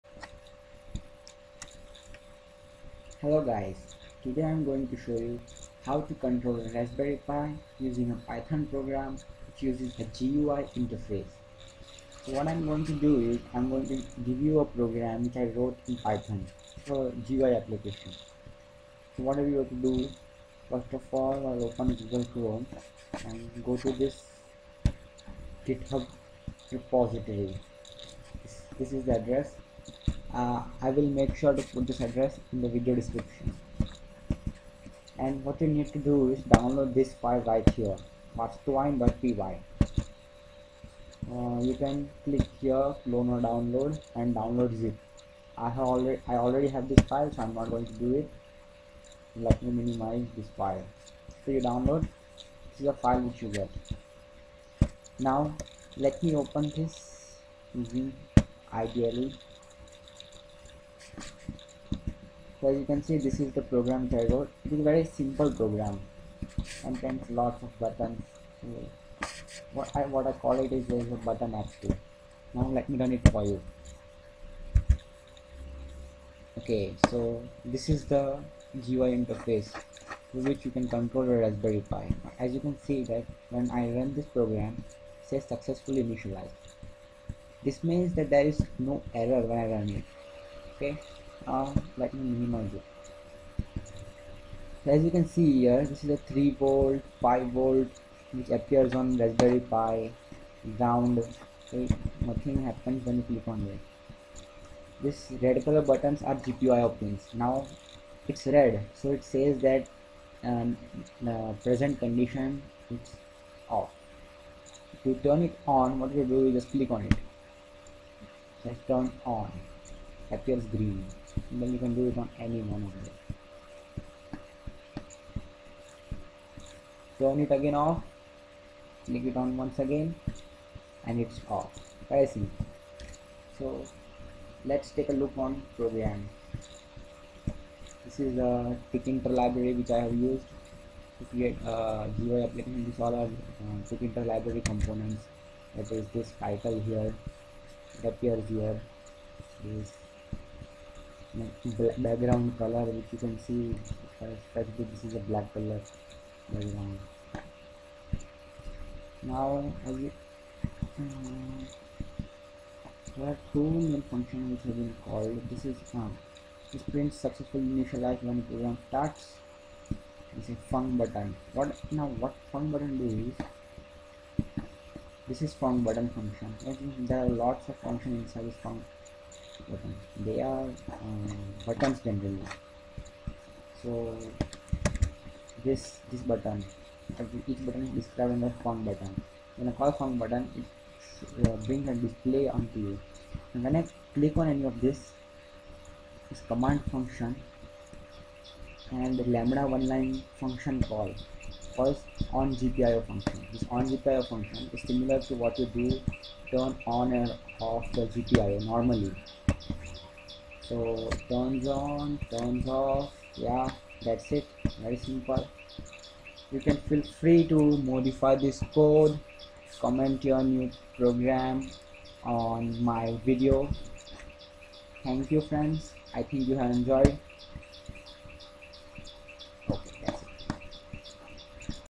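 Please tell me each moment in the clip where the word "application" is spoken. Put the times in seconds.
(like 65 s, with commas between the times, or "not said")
17 s, 142 s.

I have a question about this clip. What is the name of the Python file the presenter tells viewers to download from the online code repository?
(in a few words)
masterwine.py.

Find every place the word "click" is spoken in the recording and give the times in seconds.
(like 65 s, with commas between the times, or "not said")
42 s, 103 s, 116 s, 129 s, 194 s.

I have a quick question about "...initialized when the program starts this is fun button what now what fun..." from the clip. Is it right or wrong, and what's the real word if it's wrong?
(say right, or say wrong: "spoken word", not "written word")
right.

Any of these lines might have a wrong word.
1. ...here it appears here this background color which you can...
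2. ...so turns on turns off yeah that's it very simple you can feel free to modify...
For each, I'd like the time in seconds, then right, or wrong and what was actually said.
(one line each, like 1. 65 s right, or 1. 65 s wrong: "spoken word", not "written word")
1. 146 s right
2. 210 s right.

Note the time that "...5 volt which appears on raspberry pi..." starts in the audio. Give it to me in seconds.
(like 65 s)
97 s.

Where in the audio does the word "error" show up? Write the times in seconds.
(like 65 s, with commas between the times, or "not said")
89 s.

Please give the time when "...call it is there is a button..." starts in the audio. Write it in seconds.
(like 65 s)
70 s.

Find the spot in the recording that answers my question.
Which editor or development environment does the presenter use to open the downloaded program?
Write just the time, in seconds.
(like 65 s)
58 s.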